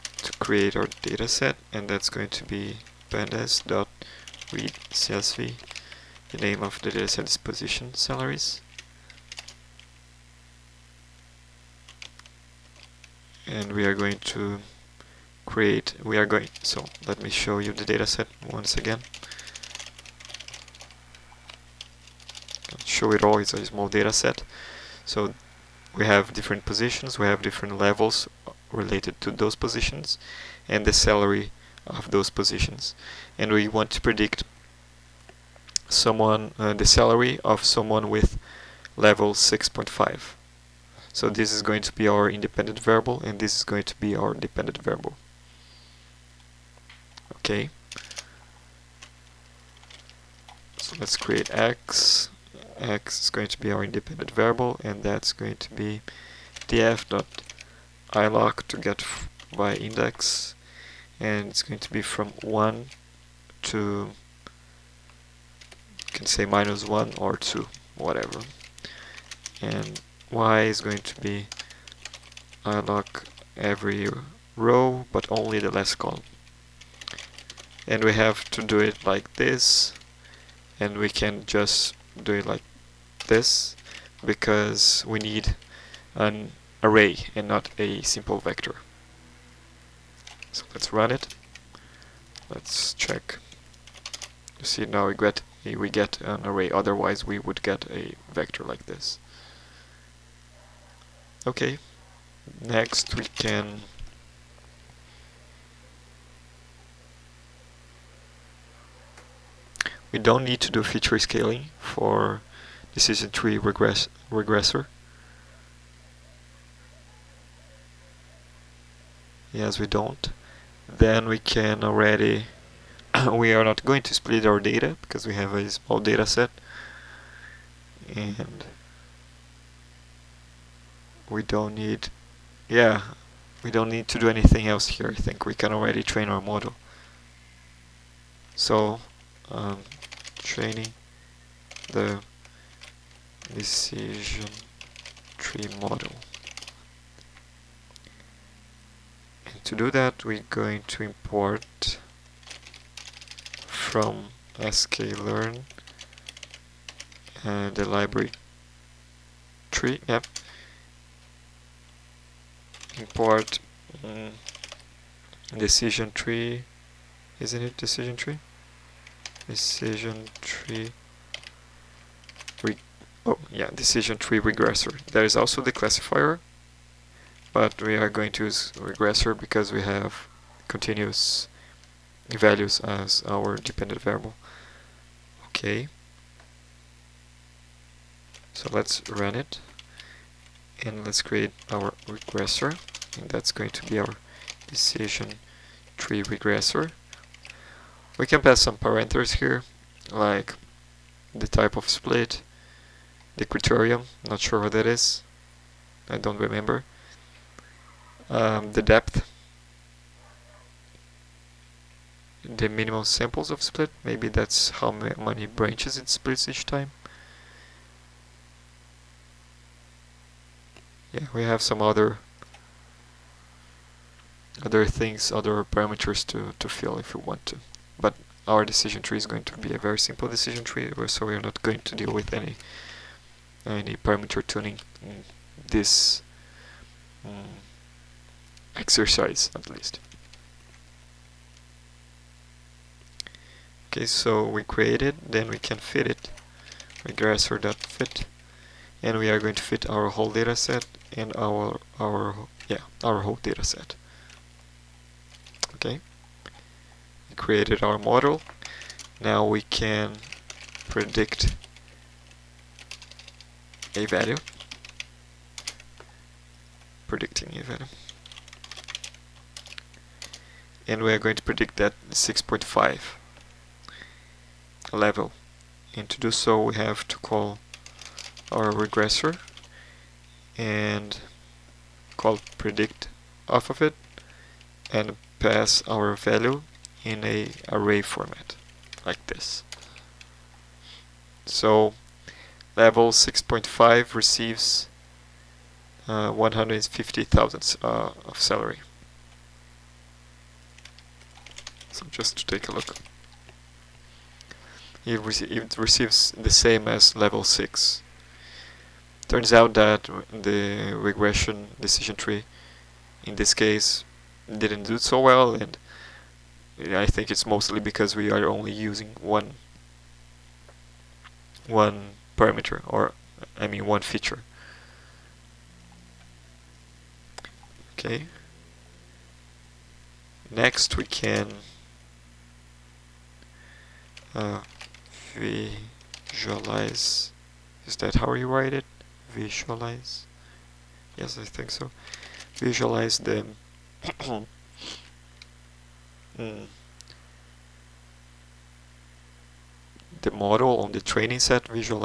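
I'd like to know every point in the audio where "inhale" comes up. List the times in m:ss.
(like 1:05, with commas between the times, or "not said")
not said.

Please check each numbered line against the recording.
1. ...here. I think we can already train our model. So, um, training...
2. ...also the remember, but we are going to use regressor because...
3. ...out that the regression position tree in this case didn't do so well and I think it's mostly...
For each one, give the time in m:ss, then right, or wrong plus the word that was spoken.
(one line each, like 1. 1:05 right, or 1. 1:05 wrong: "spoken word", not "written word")
1. 2:14 right
2. 2:55 wrong: "classifier", not "remember"
3. 5:09 wrong: "decision", not "position".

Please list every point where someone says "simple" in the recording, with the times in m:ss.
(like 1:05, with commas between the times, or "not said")
1:28, 3:49.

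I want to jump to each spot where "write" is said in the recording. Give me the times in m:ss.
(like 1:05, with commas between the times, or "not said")
5:38.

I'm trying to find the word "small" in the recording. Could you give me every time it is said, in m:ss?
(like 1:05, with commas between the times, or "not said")
0:23, 2:05.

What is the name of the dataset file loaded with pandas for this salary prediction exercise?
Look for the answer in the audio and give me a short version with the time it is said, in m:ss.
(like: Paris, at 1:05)
Position Salaries, at 0:07.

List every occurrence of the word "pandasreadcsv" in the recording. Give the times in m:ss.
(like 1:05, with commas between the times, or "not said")
0:03.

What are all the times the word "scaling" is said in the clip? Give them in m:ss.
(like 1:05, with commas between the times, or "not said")
1:51.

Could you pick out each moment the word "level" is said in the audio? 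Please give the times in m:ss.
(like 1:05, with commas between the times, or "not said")
0:27, 0:38, 4:34, 4:52, 5:07.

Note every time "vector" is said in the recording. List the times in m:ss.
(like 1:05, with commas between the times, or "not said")
1:28, 1:38.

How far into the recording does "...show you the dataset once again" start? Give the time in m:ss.
0:17.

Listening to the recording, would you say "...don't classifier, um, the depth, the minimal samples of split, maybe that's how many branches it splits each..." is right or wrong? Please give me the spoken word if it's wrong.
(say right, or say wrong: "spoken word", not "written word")
wrong: "remember", not "classifier".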